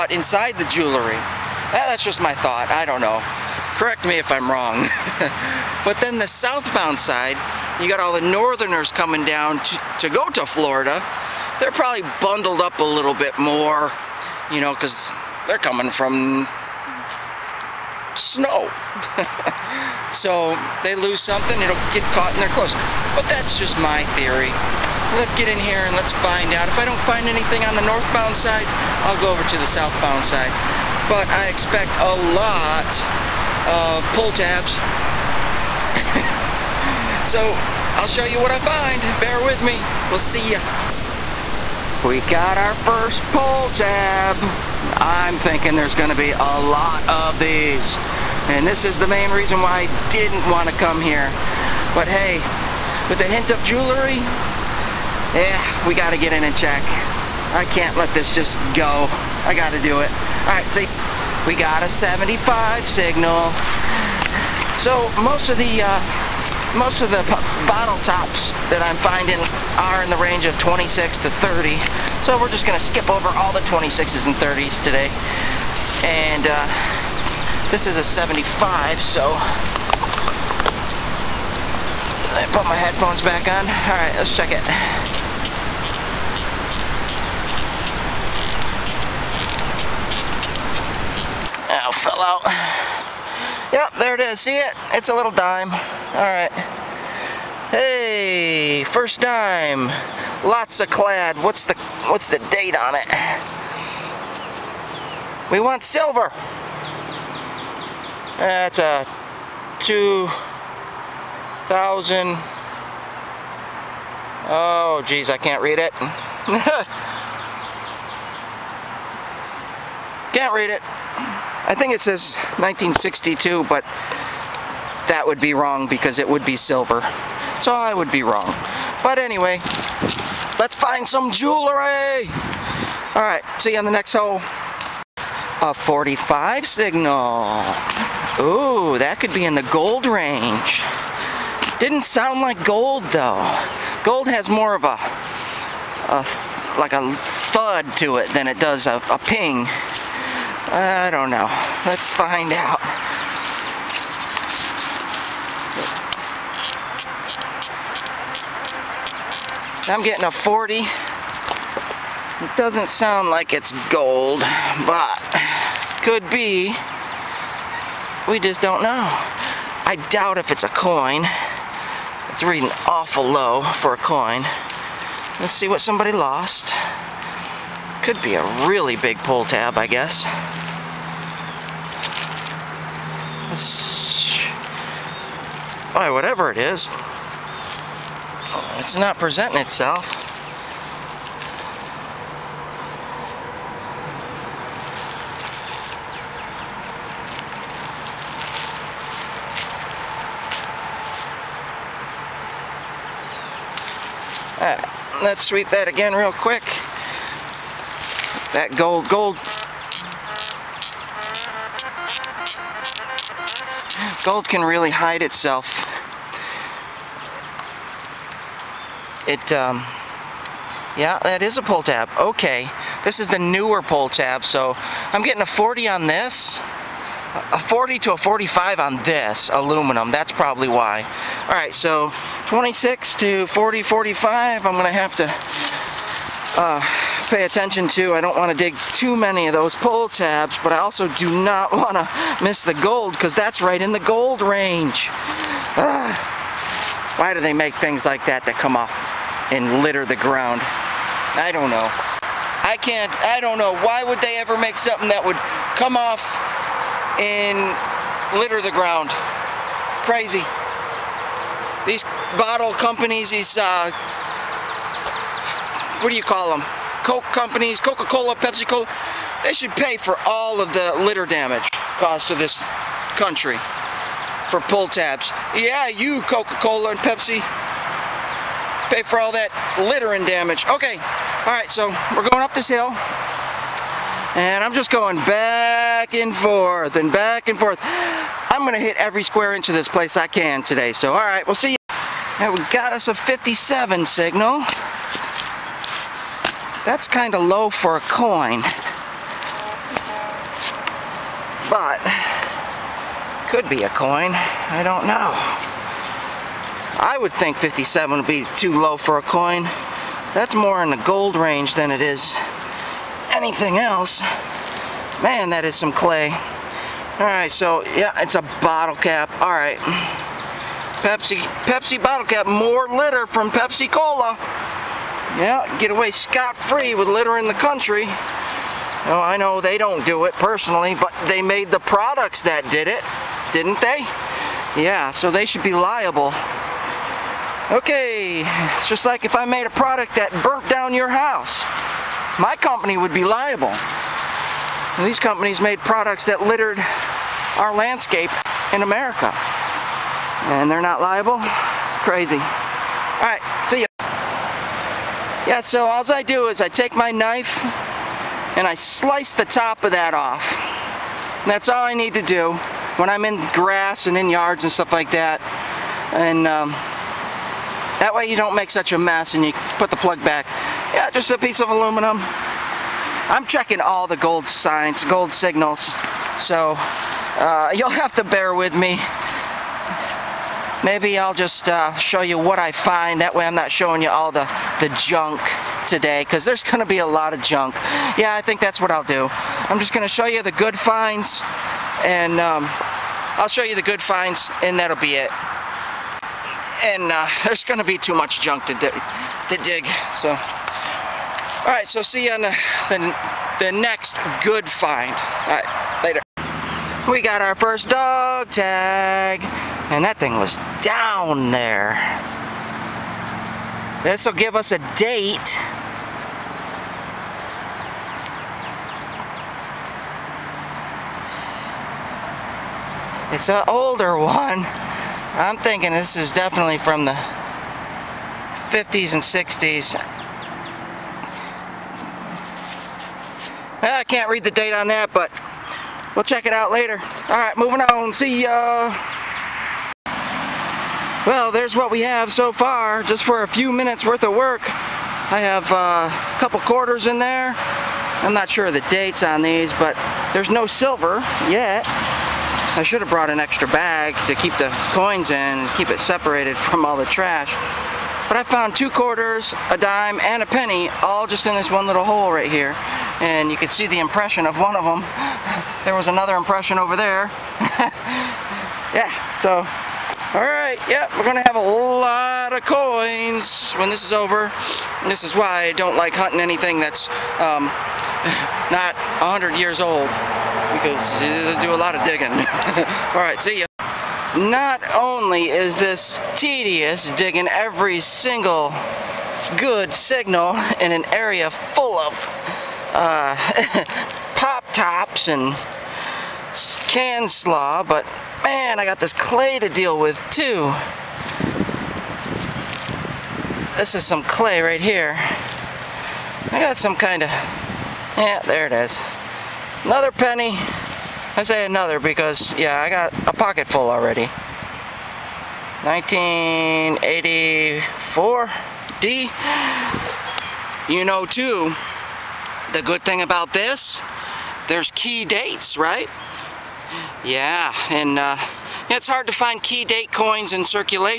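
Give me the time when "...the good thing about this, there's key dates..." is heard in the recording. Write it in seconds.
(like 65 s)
522 s.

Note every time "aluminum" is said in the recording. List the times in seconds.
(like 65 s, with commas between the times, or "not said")
229 s, 371 s.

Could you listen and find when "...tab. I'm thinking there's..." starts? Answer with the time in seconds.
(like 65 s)
43 s.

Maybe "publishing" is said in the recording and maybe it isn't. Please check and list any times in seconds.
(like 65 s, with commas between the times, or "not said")
not said.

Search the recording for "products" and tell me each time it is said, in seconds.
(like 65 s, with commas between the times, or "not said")
331 s, 339 s, 345 s.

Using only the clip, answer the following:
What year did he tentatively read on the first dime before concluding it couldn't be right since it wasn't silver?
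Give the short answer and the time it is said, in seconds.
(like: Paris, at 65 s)
1962, at 122 s.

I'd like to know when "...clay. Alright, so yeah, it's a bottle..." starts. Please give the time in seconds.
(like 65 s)
315 s.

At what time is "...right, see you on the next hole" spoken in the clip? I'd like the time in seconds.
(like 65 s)
133 s.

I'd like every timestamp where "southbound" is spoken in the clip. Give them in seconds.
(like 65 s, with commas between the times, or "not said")
6 s, 29 s.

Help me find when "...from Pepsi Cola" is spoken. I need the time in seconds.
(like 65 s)
323 s.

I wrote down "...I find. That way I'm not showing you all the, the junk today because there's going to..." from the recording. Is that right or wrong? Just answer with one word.
right.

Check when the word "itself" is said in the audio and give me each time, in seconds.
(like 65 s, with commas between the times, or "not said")
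189 s, 215 s.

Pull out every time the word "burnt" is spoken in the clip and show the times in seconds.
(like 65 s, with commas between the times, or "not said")
340 s.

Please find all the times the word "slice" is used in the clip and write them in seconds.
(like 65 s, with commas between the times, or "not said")
358 s.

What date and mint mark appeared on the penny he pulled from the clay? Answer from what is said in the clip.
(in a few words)
1984D.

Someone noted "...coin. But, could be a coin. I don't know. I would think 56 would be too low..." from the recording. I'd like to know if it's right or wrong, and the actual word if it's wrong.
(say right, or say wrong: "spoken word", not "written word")
wrong: "57", not "56".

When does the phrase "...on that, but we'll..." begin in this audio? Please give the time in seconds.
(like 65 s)
434 s.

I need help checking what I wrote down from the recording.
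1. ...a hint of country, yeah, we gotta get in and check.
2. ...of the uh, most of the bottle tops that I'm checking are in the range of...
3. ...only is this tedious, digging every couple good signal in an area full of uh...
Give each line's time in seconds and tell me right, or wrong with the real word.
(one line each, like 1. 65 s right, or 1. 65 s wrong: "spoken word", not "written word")
1. 53 s wrong: "jewelry", not "country"
2. 65 s wrong: "finding", not "checking"
3. 484 s wrong: "single", not "couple".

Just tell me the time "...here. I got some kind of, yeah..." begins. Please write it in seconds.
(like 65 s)
504 s.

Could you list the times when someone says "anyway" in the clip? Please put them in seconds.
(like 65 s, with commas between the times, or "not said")
129 s.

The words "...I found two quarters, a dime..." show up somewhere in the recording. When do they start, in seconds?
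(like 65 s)
458 s.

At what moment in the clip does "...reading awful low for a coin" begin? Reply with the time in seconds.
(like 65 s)
172 s.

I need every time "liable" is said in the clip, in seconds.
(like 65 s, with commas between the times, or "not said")
335 s, 343 s, 350 s.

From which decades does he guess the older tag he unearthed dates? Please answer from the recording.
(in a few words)
50s and 60s.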